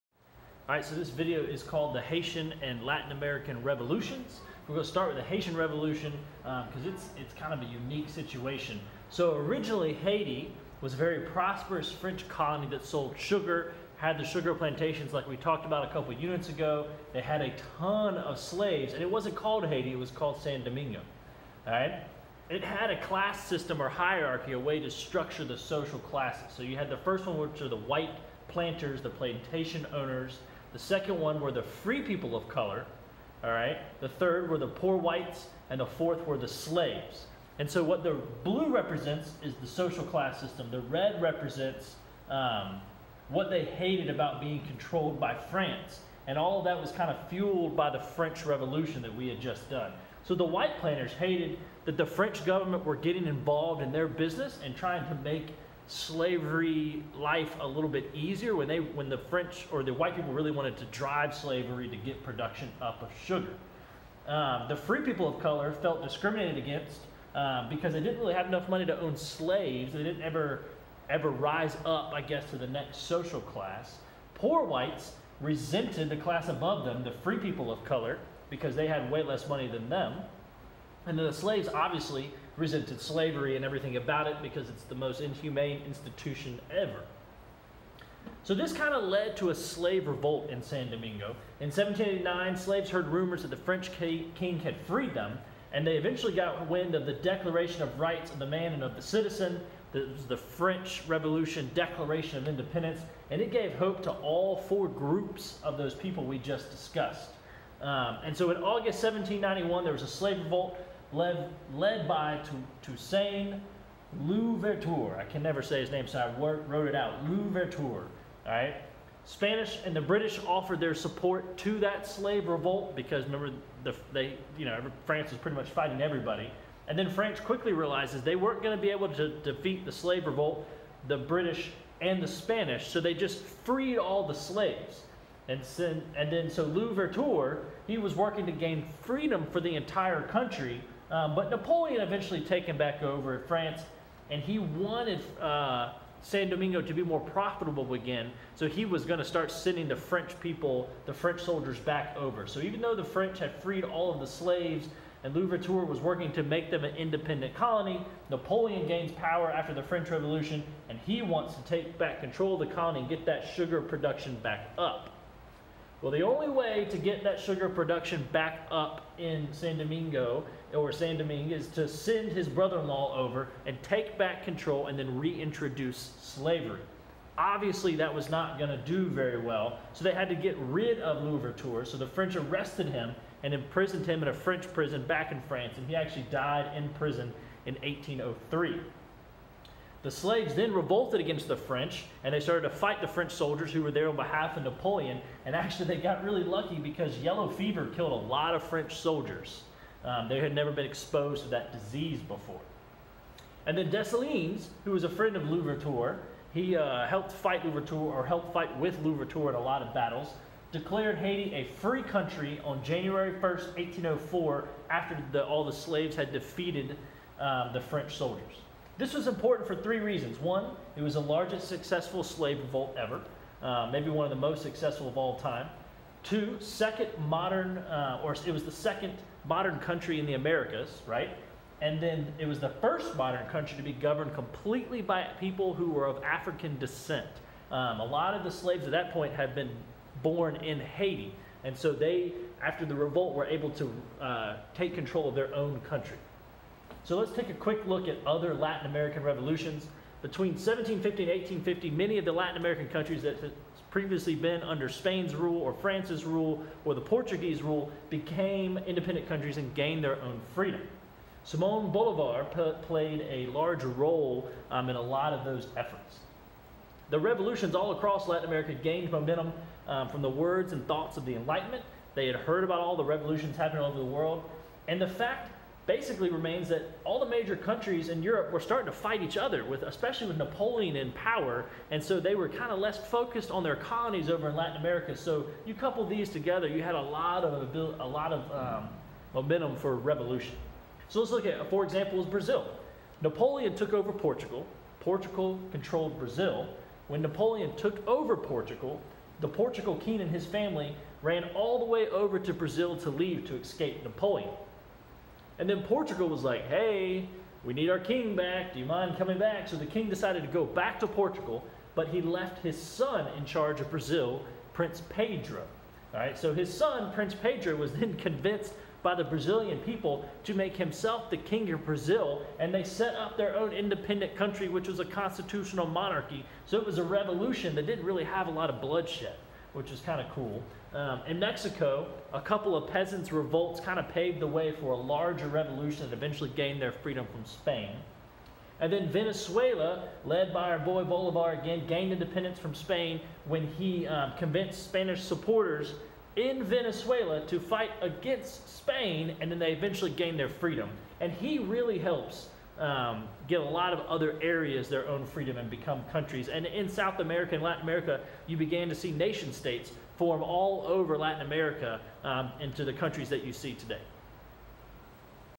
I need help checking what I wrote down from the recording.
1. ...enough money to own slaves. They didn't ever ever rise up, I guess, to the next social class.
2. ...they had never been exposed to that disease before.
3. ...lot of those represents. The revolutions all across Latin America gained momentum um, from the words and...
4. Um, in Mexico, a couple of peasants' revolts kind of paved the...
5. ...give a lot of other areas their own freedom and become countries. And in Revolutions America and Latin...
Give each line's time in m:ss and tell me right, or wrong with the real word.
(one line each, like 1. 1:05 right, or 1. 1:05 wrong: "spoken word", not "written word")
1. 1:08 right
2. 3:20 right
3. 4:25 wrong: "efforts", not "represents"
4. 5:30 right
5. 5:53 wrong: "South", not "Revolutions".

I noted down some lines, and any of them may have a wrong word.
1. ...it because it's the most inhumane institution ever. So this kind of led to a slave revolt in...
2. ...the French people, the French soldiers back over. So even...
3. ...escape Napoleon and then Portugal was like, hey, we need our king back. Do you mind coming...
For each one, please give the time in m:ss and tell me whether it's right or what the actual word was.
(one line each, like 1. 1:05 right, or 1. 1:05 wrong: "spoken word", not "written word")
1. 1:24 right
2. 2:29 right
3. 5:03 right.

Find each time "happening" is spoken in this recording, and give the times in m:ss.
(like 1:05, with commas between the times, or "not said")
4:33.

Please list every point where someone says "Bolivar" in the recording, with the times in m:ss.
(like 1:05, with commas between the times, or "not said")
4:21, 5:41.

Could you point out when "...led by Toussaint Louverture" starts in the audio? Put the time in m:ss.
1:51.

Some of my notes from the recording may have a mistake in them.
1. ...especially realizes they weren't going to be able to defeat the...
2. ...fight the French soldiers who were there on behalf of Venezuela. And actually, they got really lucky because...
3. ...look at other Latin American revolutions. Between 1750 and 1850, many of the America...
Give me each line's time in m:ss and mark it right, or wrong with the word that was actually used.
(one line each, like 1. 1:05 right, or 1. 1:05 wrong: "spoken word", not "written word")
1. 2:07 wrong: "quickly", not "especially"
2. 3:12 wrong: "Napoleon", not "Venezuela"
3. 4:07 wrong: "Latin", not "America".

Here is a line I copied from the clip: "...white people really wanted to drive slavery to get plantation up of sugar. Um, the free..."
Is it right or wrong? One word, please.
wrong.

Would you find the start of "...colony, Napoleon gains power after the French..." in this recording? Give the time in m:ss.
2:37.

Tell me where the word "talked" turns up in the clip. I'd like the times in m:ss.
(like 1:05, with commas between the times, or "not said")
0:15.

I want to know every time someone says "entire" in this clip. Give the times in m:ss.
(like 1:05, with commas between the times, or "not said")
2:19.